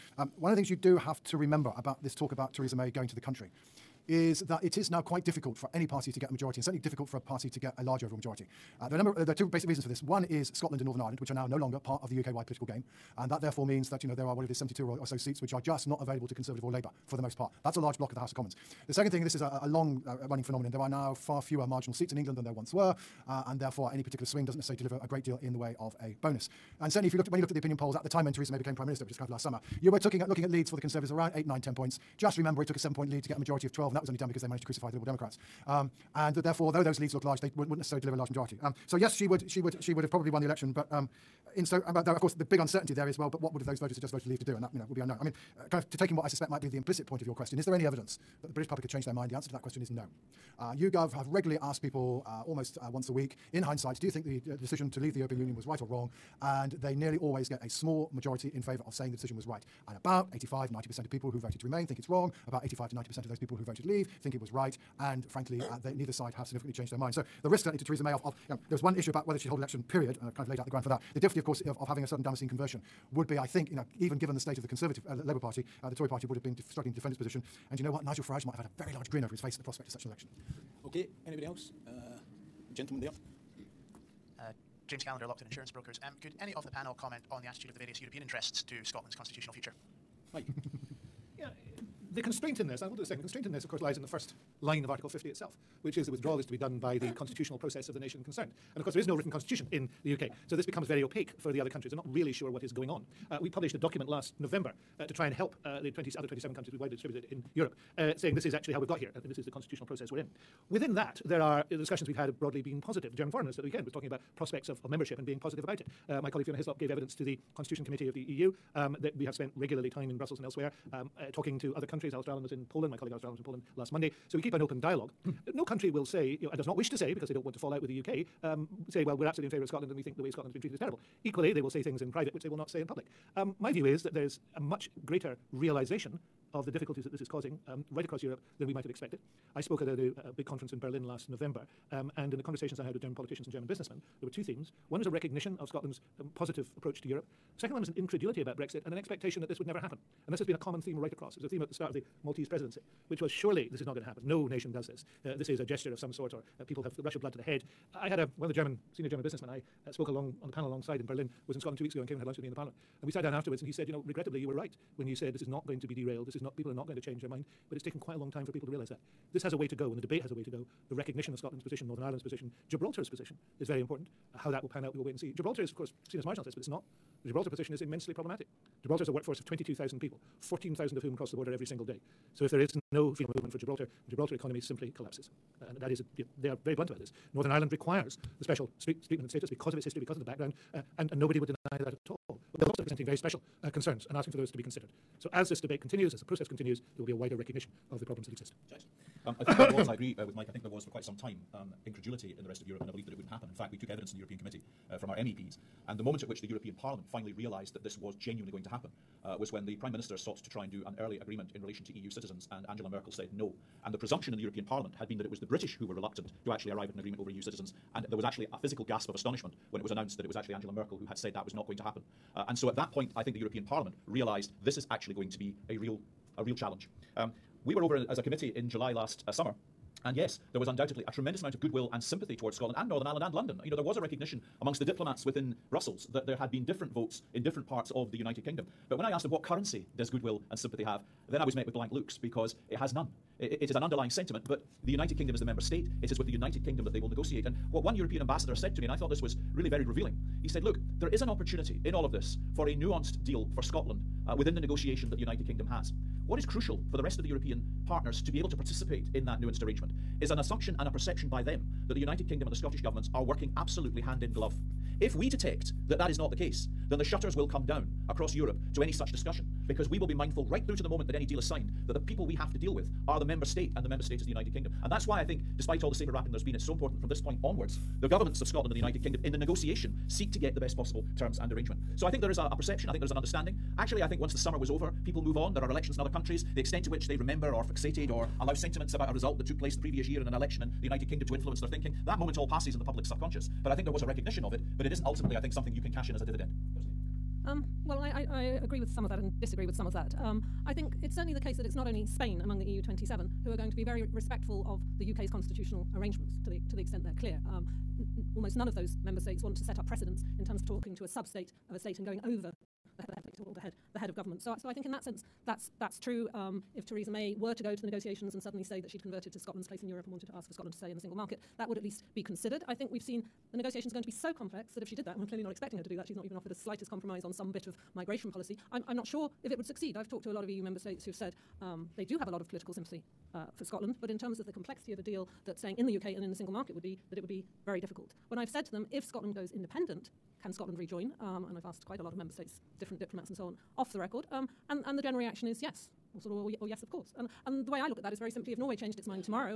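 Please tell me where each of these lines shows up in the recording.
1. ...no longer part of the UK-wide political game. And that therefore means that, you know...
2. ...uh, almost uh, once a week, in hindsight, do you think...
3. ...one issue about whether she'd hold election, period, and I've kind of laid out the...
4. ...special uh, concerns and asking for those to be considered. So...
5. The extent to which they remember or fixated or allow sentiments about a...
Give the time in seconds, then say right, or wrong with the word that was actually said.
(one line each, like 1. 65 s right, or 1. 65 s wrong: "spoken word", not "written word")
1. 11 s right
2. 52 s right
3. 68 s right
4. 193 s right
5. 286 s right.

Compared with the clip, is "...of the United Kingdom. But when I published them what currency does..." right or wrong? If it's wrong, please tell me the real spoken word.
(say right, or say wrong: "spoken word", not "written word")
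wrong: "asked", not "published".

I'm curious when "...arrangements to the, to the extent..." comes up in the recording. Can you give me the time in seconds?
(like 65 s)
305 s.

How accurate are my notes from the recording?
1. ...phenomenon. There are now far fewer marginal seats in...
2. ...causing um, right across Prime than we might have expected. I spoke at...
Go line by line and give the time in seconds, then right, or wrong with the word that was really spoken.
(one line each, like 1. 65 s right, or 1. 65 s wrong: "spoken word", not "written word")
1. 20 s right
2. 137 s wrong: "Europe", not "Prime".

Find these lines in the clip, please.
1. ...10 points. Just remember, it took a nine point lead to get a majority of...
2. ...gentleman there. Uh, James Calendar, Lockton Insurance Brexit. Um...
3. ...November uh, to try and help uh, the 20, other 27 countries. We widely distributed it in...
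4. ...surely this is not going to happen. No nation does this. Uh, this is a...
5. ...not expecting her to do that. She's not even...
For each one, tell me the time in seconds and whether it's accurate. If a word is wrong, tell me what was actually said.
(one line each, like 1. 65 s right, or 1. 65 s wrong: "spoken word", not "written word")
1. 31 s wrong: "seven", not "nine"
2. 82 s wrong: "Brokers", not "Brexit"
3. 104 s right
4. 153 s right
5. 325 s right.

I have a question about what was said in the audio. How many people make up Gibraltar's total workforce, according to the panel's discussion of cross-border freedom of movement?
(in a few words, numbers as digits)
22,000.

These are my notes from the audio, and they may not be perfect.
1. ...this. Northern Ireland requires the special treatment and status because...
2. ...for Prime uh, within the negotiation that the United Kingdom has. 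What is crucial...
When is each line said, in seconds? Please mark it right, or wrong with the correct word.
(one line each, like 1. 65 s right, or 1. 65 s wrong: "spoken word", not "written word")
1. 186 s right
2. 253 s wrong: "Scotland", not "Prime".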